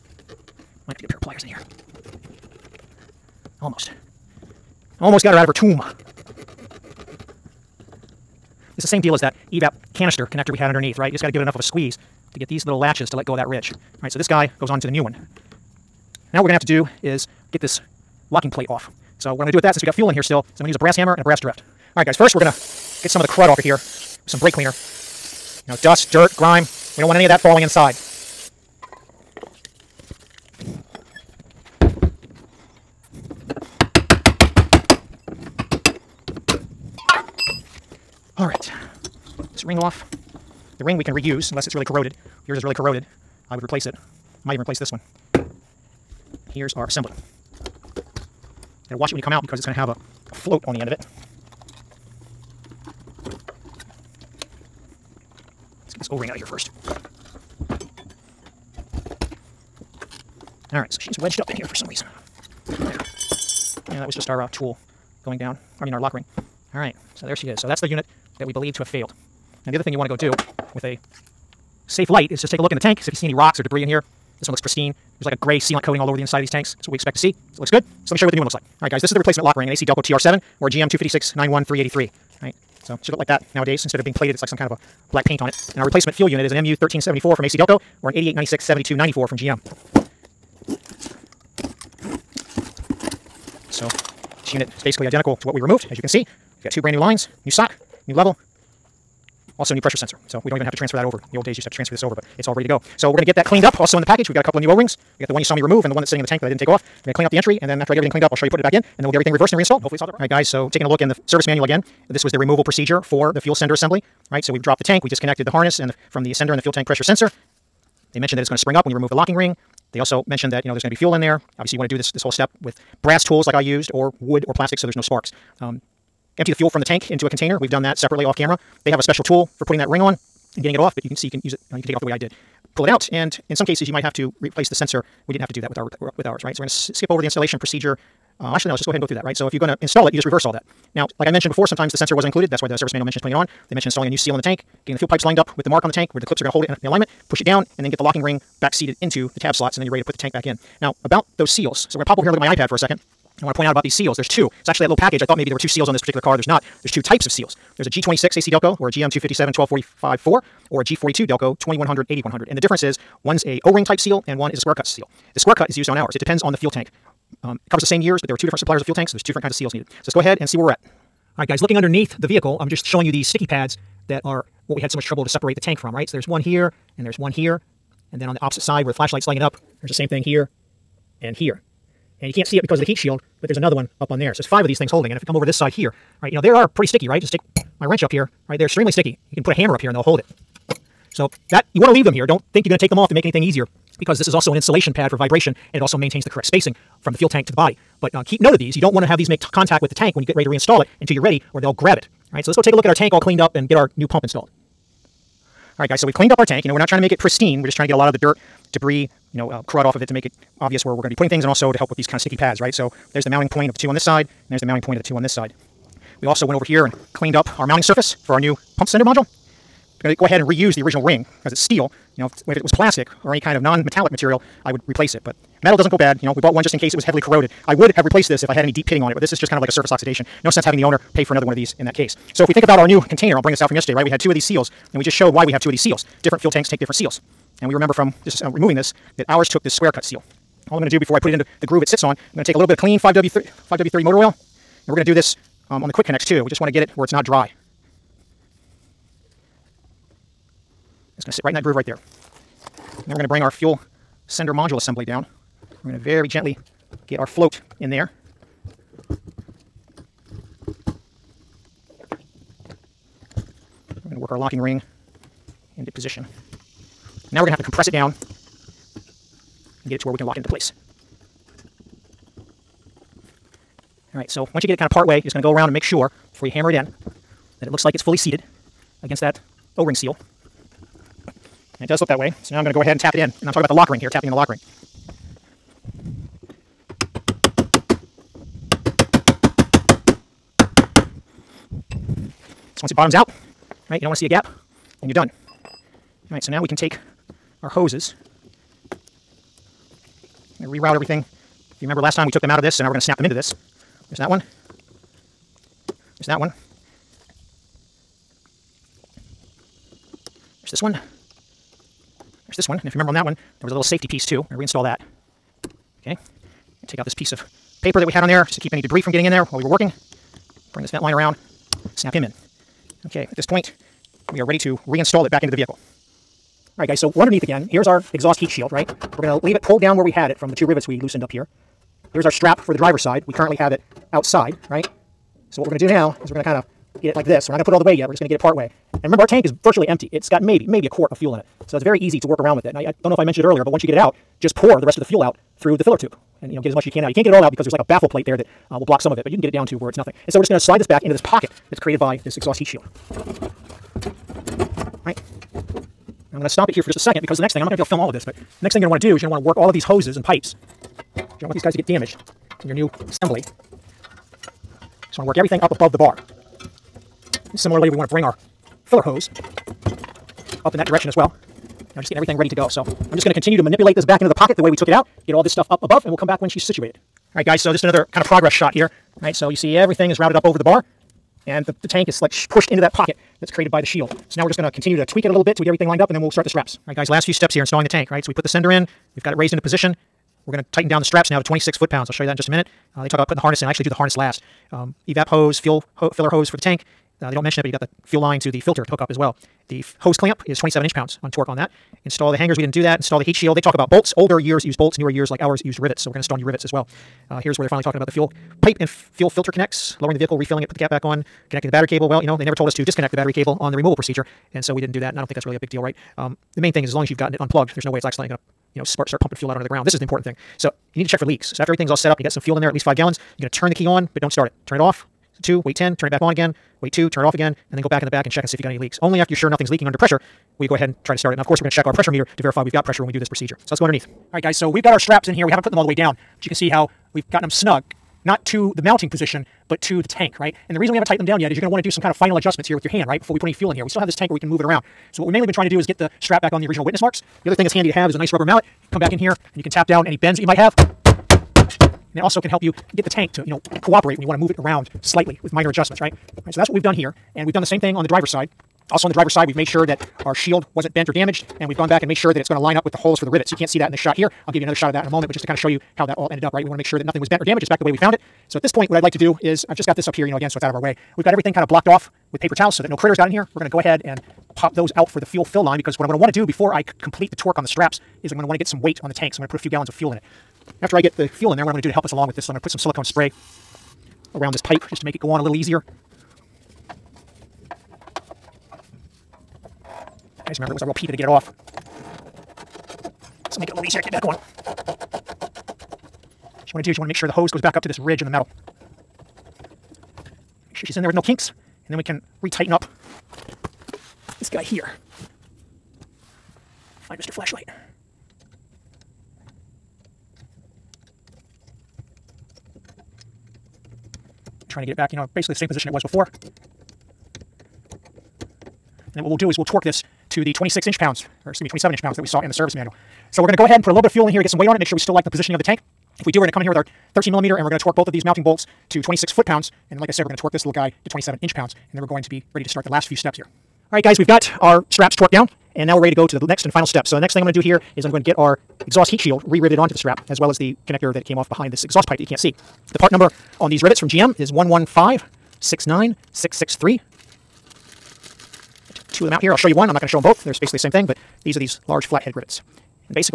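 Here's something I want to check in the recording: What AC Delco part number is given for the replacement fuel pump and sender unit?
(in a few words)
MU1374.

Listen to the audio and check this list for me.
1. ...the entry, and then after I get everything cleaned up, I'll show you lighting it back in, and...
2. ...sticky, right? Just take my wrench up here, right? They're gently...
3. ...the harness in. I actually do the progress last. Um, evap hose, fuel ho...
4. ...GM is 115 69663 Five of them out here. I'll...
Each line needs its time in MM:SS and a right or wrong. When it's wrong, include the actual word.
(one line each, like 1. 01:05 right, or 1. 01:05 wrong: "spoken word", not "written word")
1. 01:47 wrong: "putting", not "lighting"
2. 03:06 wrong: "extremely", not "gently"
3. 06:33 wrong: "harness", not "progress"
4. 09:04 wrong: "Two", not "Five".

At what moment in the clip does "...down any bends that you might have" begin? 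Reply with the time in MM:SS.
07:29.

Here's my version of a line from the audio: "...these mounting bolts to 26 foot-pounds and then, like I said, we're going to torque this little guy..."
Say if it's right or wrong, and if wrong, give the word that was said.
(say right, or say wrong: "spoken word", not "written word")
right.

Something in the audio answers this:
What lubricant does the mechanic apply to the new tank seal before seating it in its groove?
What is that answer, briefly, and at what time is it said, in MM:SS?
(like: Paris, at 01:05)
5W30 motor oil, at 04:03.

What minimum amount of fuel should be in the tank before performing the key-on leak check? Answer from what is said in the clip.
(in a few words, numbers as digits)
5 gallons.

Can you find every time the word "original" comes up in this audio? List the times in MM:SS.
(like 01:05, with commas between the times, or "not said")
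03:40, 07:26.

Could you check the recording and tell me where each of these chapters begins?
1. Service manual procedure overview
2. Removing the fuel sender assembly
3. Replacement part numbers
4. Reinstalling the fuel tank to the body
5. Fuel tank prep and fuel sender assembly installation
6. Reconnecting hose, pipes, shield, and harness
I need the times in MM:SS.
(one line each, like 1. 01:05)
1. 01:49
2. 00:15
3. 01:17
4. 05:25
5. 02:51
6. 07:53.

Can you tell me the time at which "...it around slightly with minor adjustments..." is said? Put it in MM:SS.
07:34.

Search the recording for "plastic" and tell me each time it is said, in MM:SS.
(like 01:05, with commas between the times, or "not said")
02:04, 03:42.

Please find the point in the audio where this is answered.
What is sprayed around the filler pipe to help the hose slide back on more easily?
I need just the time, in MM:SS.
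08:02.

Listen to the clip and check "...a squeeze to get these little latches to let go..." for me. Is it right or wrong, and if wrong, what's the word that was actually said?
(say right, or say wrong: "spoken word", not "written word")
right.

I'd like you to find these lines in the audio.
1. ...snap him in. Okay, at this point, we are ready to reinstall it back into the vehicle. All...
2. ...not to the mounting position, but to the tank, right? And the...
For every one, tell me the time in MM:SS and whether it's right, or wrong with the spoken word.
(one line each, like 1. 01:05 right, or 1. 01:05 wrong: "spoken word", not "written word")
1. 05:21 right
2. 07:18 right.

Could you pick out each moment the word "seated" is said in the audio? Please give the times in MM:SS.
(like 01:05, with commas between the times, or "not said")
02:28, 04:38.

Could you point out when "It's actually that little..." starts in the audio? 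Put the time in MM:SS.
02:34.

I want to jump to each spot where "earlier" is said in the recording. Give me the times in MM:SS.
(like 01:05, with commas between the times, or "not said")
05:43.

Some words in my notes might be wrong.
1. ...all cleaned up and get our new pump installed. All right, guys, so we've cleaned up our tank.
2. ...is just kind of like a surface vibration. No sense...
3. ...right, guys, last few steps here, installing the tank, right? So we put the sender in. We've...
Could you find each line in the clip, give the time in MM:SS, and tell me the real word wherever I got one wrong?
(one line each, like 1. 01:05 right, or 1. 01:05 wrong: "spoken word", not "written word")
1. 03:23 right
2. 03:49 wrong: "oxidation", not "vibration"
3. 06:26 right.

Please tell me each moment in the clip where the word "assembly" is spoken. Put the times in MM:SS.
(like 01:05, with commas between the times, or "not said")
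00:46, 01:53, 04:14, 06:03.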